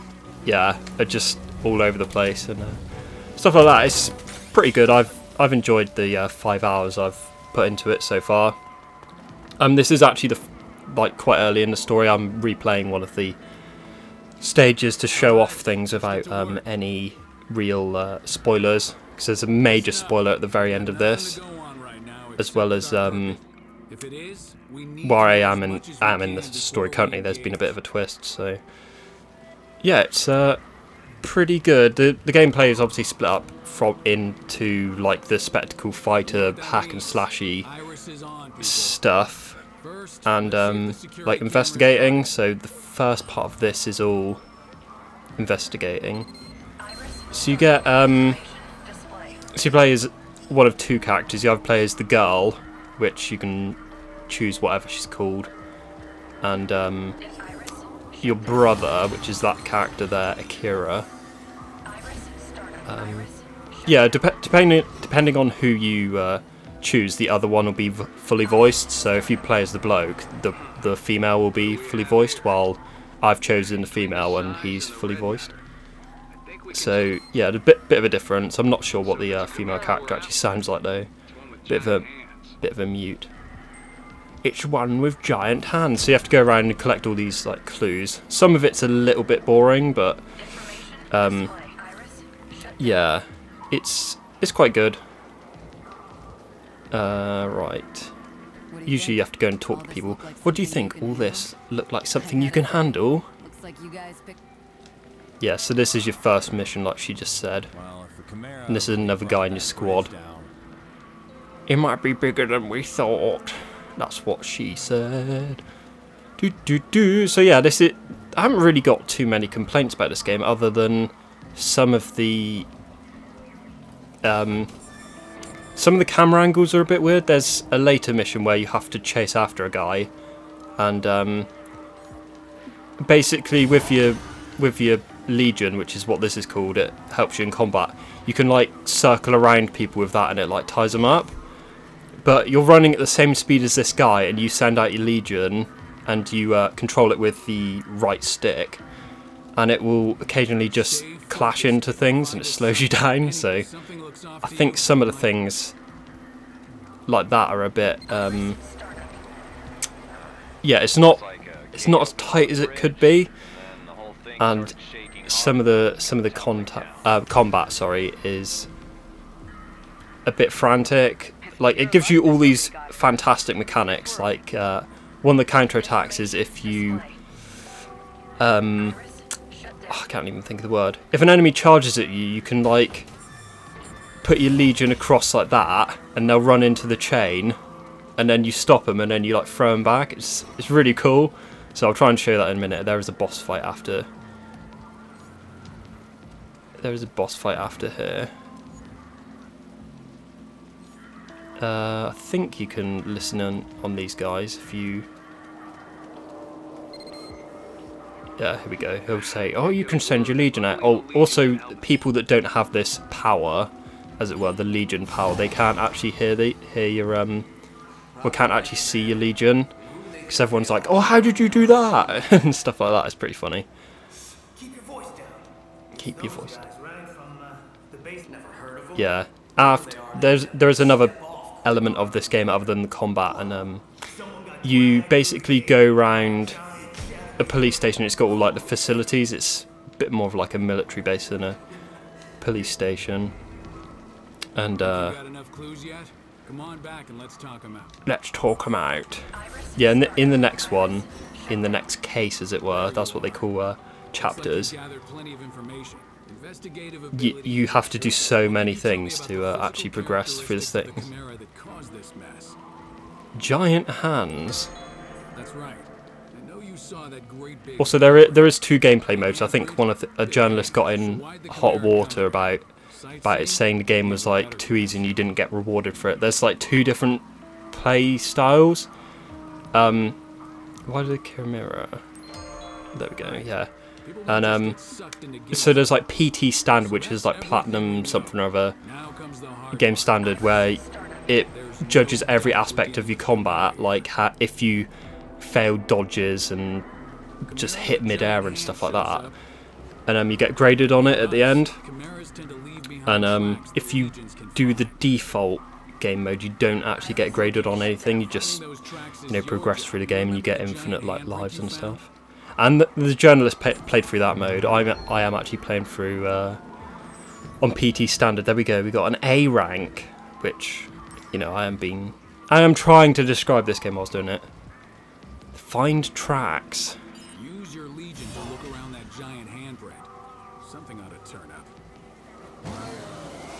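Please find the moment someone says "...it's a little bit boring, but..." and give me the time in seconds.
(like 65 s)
88 s.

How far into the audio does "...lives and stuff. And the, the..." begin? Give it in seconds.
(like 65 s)
311 s.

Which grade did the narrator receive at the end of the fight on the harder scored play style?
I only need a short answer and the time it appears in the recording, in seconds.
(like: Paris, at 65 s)
A rank, at 319 s.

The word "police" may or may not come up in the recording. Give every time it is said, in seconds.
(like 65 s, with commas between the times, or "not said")
237 s, 242 s.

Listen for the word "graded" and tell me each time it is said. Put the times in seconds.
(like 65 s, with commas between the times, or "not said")
300 s, 307 s.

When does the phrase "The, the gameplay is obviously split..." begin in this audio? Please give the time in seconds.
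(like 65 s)
31 s.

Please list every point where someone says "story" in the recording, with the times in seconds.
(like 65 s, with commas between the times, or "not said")
11 s, 26 s.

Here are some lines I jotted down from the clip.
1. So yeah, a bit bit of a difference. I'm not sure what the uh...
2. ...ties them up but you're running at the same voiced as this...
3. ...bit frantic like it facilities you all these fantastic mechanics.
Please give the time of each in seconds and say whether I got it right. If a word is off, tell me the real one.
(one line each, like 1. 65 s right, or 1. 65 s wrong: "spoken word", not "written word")
1. 76 s right
2. 140 s wrong: "speed", not "voiced"
3. 170 s wrong: "gives", not "facilities".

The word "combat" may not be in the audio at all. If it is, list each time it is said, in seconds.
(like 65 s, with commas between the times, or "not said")
137 s, 167 s, 232 s, 293 s.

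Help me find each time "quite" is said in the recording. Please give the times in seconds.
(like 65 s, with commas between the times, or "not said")
11 s, 94 s.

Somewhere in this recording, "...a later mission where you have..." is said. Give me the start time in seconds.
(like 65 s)
127 s.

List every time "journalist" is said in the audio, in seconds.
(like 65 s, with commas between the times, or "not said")
270 s, 313 s.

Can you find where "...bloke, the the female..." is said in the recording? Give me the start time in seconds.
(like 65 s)
69 s.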